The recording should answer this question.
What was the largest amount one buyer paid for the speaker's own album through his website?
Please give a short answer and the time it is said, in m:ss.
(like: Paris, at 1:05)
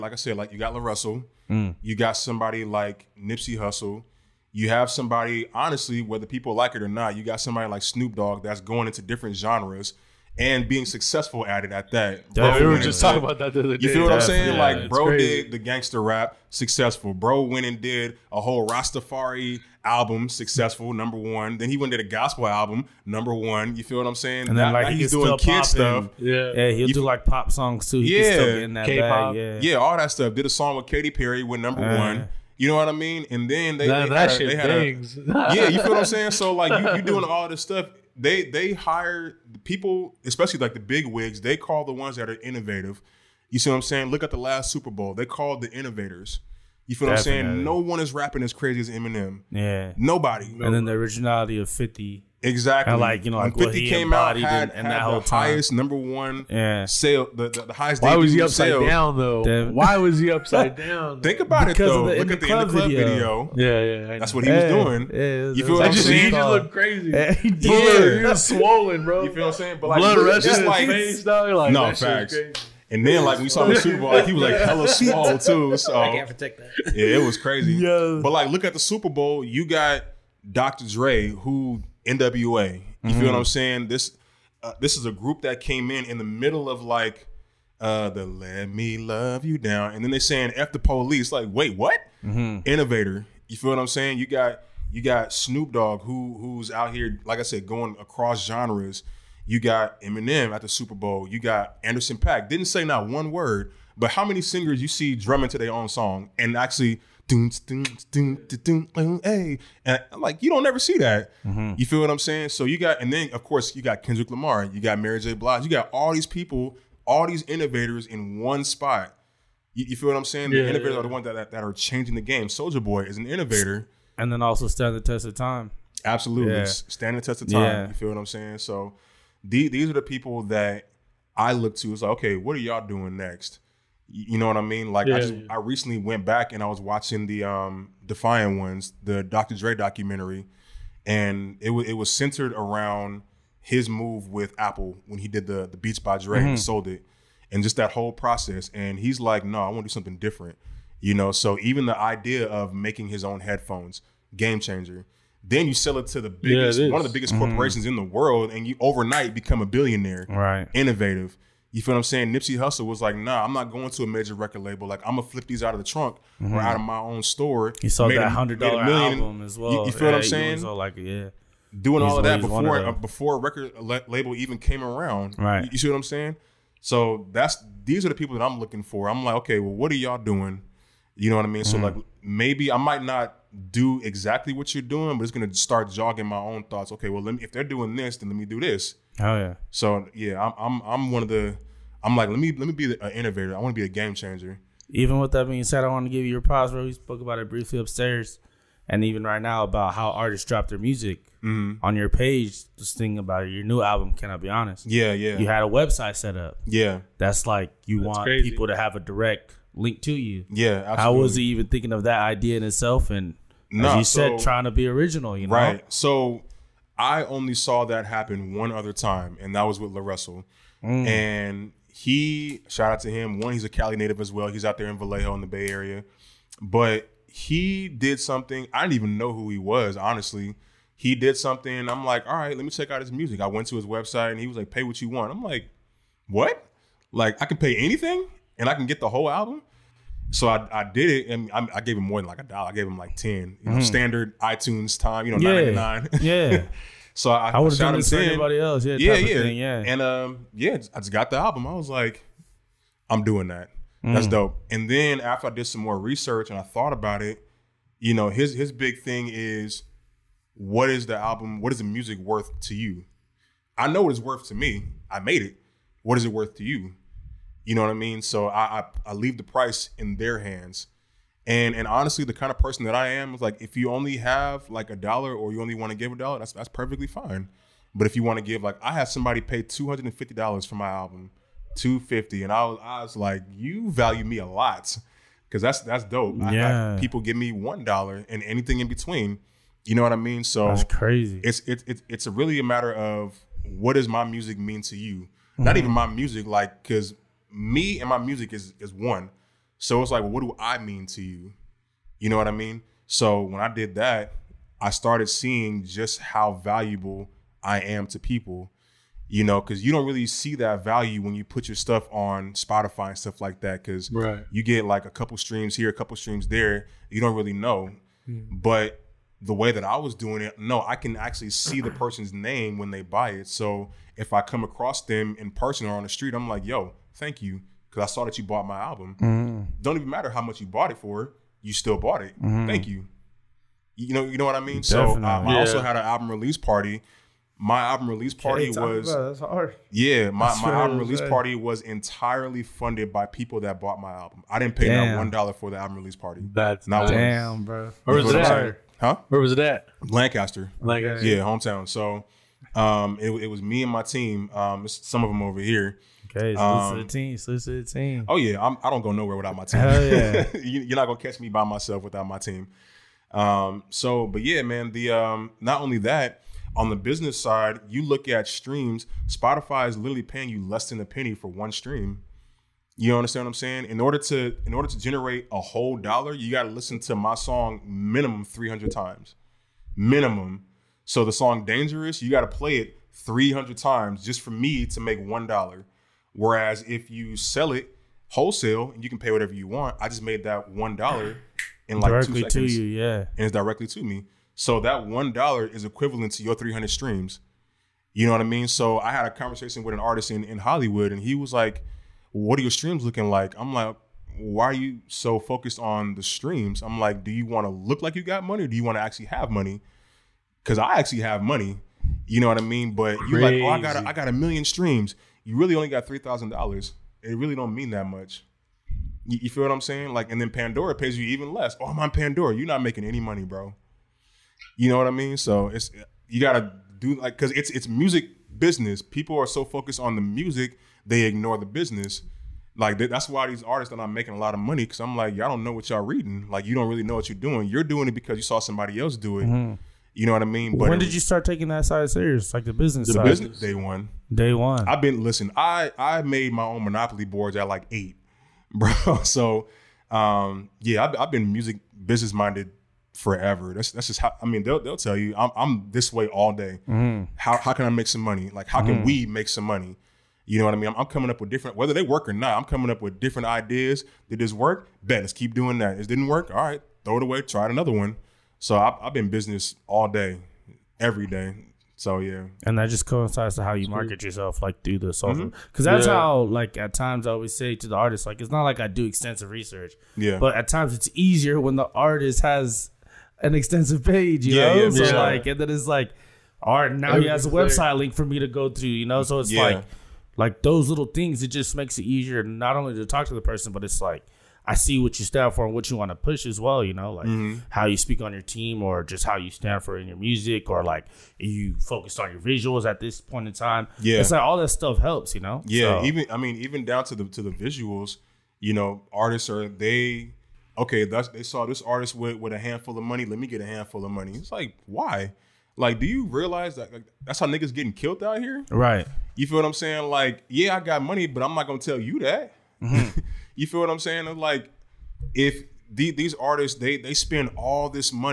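$250, at 4:39.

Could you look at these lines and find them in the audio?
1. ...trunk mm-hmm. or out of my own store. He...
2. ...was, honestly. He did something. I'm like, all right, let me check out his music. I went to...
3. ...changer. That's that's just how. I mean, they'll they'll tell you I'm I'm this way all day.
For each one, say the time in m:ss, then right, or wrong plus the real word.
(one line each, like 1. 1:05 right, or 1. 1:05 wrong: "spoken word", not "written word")
1. 2:45 right
2. 3:49 right
3. 7:33 wrong: "forever", not "changer".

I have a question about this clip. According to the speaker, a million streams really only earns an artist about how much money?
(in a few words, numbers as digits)
$3,000.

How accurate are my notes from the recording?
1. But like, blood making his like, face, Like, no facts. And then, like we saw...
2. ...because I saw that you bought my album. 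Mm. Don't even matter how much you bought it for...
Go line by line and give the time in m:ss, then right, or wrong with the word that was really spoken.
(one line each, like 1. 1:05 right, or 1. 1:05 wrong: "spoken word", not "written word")
1. 1:09 wrong: "rushing", not "making"
2. 5:27 right.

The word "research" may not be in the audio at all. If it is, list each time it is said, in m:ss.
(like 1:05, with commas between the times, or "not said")
4:15, 7:59.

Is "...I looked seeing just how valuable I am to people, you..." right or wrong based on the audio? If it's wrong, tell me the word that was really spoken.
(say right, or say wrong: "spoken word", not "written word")
wrong: "started", not "looked".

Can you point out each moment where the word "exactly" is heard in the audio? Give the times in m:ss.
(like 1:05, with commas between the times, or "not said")
0:52, 3:04.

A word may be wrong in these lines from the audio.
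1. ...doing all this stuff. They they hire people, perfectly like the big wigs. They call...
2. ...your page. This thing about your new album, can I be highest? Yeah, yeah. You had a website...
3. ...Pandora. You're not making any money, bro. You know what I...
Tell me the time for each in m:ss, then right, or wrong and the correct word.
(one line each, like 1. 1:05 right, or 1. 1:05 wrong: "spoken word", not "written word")
1. 0:37 wrong: "especially", not "perfectly"
2. 3:21 wrong: "honest", not "highest"
3. 7:02 right.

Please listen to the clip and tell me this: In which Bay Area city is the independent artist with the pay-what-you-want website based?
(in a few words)
Vallejo.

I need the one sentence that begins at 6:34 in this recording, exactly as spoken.
So that one dollar is equivalent to your three hundred streams.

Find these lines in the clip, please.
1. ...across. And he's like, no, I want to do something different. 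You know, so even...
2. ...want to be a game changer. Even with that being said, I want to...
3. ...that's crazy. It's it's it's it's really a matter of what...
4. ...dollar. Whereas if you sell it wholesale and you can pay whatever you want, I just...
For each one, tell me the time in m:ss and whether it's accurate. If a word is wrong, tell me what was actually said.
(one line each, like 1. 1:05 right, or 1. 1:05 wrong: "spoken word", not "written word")
1. 2:28 wrong: "process", not "across"
2. 3:13 right
3. 4:50 right
4. 6:25 right.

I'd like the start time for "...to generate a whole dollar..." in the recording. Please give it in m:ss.
6:14.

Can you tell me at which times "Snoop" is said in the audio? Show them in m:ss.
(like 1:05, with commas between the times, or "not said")
0:07, 1:35.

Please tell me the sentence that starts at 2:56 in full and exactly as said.
So that's these are the people that I'm looking for.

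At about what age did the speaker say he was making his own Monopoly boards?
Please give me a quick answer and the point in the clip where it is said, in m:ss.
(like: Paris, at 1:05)
8, at 7:27.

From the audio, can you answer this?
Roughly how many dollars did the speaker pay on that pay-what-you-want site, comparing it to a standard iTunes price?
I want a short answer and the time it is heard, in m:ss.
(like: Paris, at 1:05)
10, at 4:03.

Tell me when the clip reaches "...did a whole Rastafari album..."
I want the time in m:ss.
0:17.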